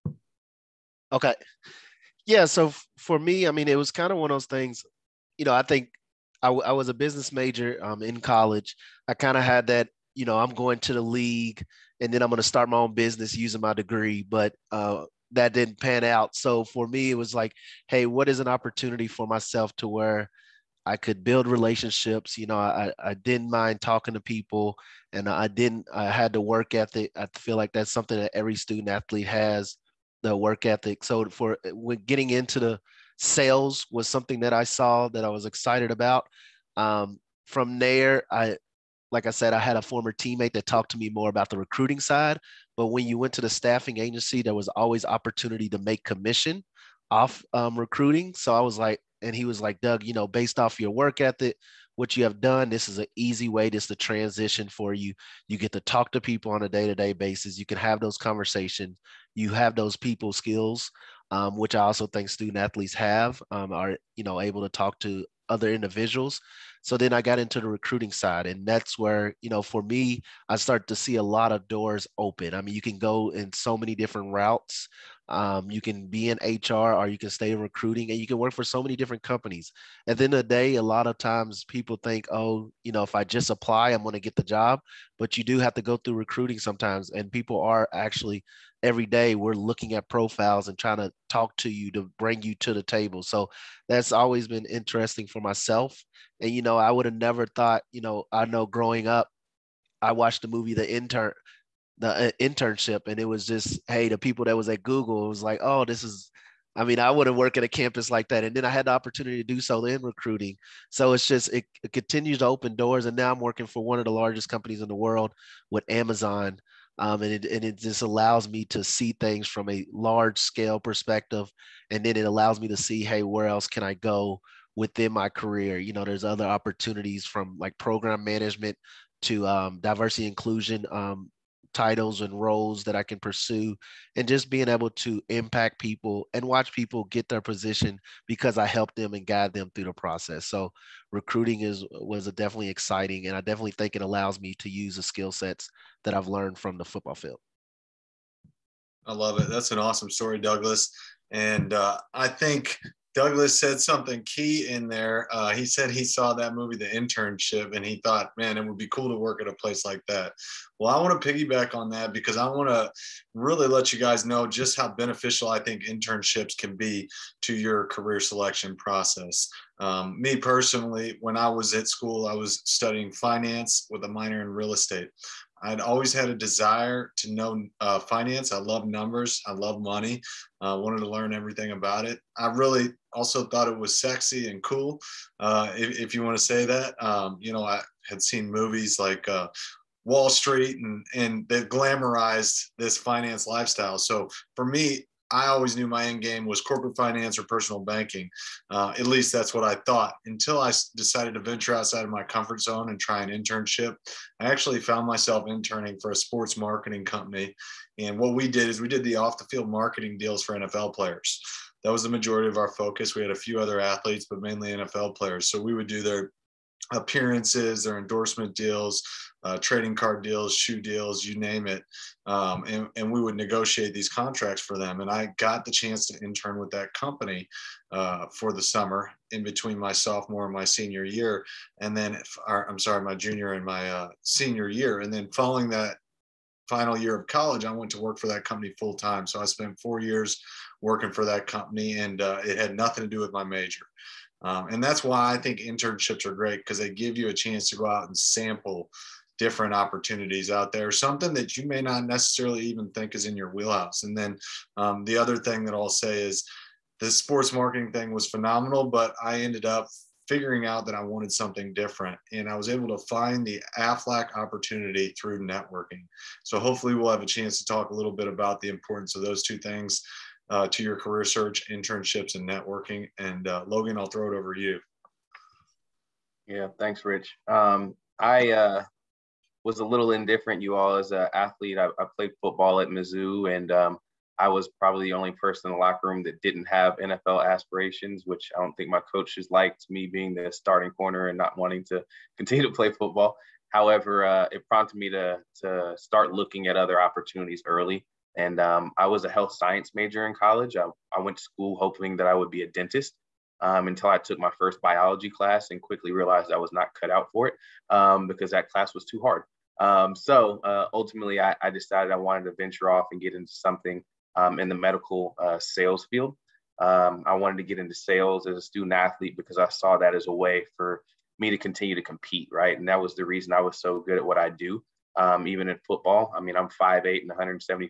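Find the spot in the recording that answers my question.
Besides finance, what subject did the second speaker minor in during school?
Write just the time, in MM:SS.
02:54.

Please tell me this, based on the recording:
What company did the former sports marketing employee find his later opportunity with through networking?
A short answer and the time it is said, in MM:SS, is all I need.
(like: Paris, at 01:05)
AFLAC, at 04:23.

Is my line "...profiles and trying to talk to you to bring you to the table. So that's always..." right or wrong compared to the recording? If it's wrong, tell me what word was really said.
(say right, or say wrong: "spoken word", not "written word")
right.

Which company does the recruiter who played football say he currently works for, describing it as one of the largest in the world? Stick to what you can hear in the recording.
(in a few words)
Amazon.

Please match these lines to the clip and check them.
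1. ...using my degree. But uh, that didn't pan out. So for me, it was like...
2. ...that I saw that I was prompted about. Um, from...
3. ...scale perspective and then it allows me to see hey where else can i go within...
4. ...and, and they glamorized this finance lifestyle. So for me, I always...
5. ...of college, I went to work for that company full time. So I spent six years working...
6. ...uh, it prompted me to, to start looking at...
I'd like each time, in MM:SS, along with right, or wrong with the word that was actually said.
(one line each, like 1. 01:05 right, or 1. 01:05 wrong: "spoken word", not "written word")
1. 00:13 right
2. 00:34 wrong: "excited", not "prompted"
3. 02:00 right
4. 03:10 right
5. 03:57 wrong: "four", not "six"
6. 04:54 right.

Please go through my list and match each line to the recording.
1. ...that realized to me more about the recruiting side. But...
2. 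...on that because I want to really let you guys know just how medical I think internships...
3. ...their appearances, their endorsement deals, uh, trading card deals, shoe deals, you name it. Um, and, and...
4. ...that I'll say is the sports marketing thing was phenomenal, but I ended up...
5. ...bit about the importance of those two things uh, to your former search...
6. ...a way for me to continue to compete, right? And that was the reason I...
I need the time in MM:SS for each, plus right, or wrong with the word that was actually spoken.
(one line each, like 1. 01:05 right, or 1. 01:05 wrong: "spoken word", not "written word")
1. 00:40 wrong: "talked", not "realized"
2. 02:41 wrong: "beneficial", not "medical"
3. 03:36 right
4. 04:15 right
5. 04:28 wrong: "career", not "former"
6. 05:20 right.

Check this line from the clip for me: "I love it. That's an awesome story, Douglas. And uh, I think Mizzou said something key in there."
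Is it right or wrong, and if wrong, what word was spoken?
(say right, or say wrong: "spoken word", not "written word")
wrong: "Douglas", not "Mizzou".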